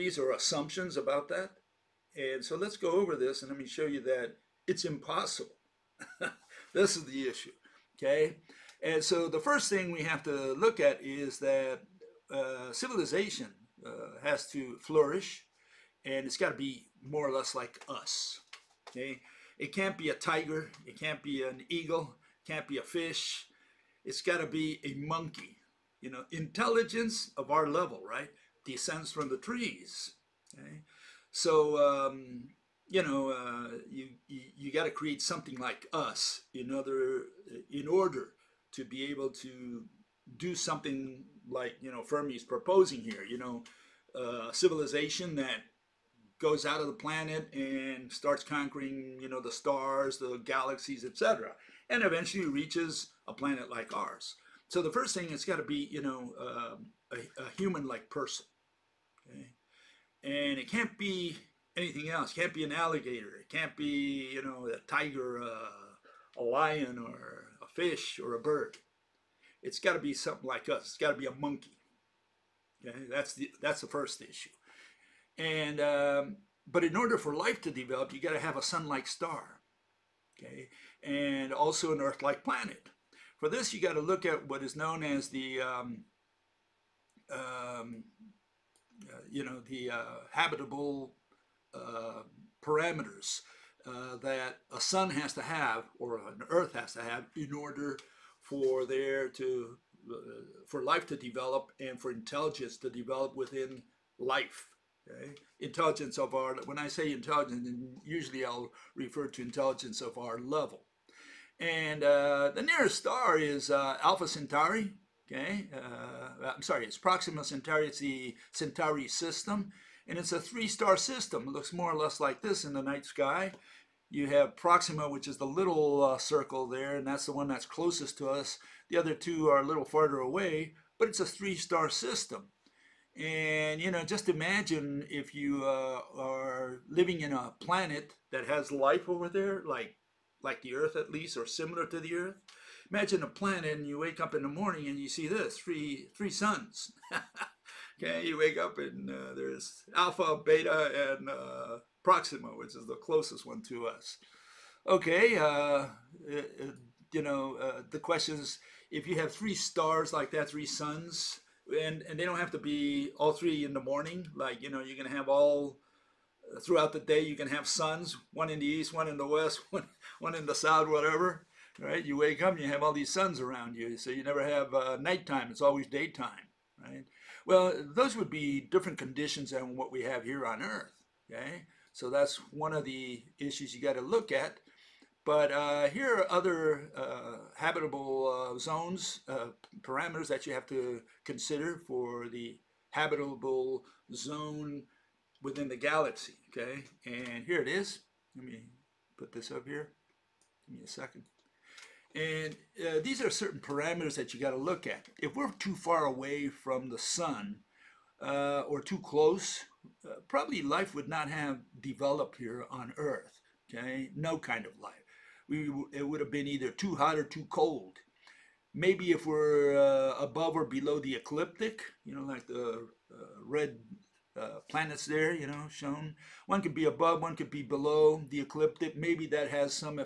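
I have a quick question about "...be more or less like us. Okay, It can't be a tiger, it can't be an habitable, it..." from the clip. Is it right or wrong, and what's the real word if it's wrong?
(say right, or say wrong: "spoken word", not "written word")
wrong: "eagle", not "habitable".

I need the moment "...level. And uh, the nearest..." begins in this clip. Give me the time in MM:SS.
01:50.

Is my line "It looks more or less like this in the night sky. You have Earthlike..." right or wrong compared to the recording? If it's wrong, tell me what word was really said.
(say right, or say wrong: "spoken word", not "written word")
wrong: "Proxima", not "Earthlike".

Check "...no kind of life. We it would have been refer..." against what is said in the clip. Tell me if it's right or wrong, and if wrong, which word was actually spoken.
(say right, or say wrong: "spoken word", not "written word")
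wrong: "either", not "refer".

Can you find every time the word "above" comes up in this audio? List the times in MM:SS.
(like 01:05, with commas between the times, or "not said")
03:40, 03:46.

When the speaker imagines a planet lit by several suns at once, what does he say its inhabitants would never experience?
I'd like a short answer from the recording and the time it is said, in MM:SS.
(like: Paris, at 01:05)
Nighttime, at 02:54.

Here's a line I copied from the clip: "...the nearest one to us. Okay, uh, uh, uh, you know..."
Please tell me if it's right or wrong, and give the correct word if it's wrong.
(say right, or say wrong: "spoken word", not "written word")
wrong: "closest", not "nearest".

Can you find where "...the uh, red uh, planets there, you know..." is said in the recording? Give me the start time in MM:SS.
03:42.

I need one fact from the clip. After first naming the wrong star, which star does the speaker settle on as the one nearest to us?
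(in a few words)
Proxima Centauri.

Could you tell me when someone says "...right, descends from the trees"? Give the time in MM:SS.
00:28.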